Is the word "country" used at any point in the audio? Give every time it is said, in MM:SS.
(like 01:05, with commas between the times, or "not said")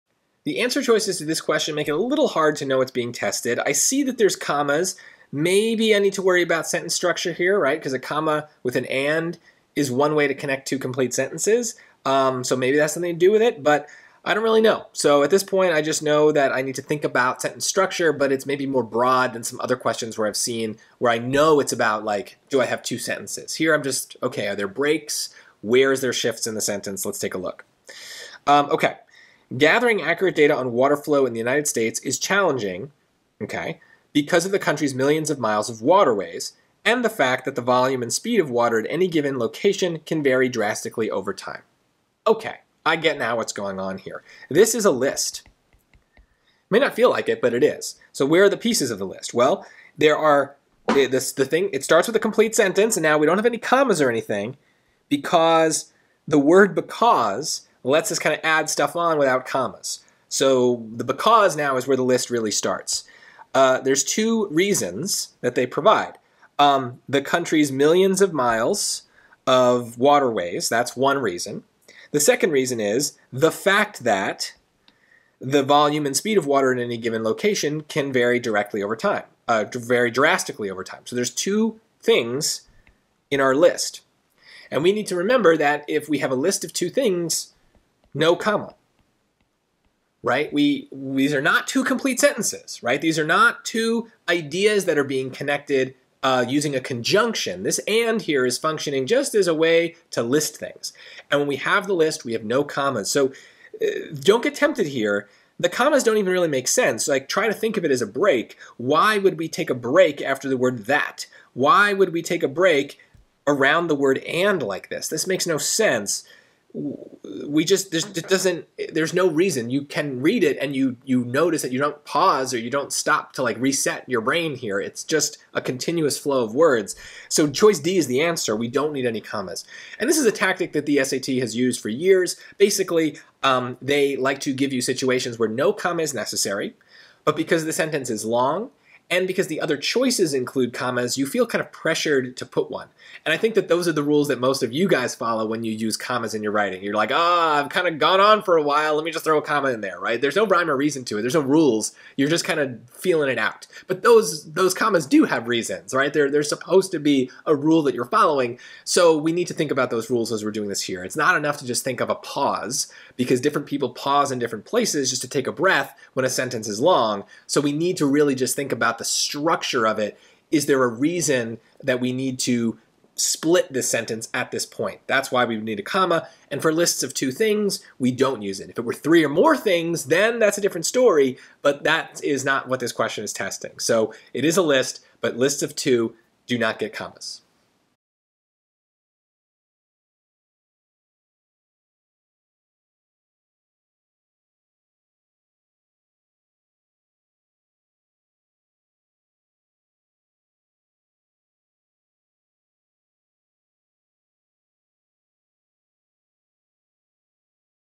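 00:34, 01:07.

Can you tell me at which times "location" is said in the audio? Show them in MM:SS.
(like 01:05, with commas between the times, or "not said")
00:39, 01:17.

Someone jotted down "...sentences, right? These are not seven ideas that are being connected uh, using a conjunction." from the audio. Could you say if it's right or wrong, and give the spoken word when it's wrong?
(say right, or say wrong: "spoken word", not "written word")
wrong: "two", not "seven".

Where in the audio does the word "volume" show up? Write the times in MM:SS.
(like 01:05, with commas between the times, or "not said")
00:37, 01:15.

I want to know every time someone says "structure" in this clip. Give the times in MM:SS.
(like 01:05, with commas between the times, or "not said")
00:06, 00:17, 02:49.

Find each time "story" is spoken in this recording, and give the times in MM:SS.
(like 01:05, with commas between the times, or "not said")
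03:00.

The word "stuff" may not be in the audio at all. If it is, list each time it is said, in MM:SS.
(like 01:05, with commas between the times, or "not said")
00:58.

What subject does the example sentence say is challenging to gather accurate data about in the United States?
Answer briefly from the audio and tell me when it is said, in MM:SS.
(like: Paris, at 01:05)
water flow, at 00:30.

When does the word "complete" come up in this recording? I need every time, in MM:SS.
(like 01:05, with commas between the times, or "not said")
00:10, 00:52, 01:31.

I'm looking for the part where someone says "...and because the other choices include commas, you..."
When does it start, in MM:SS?
02:19.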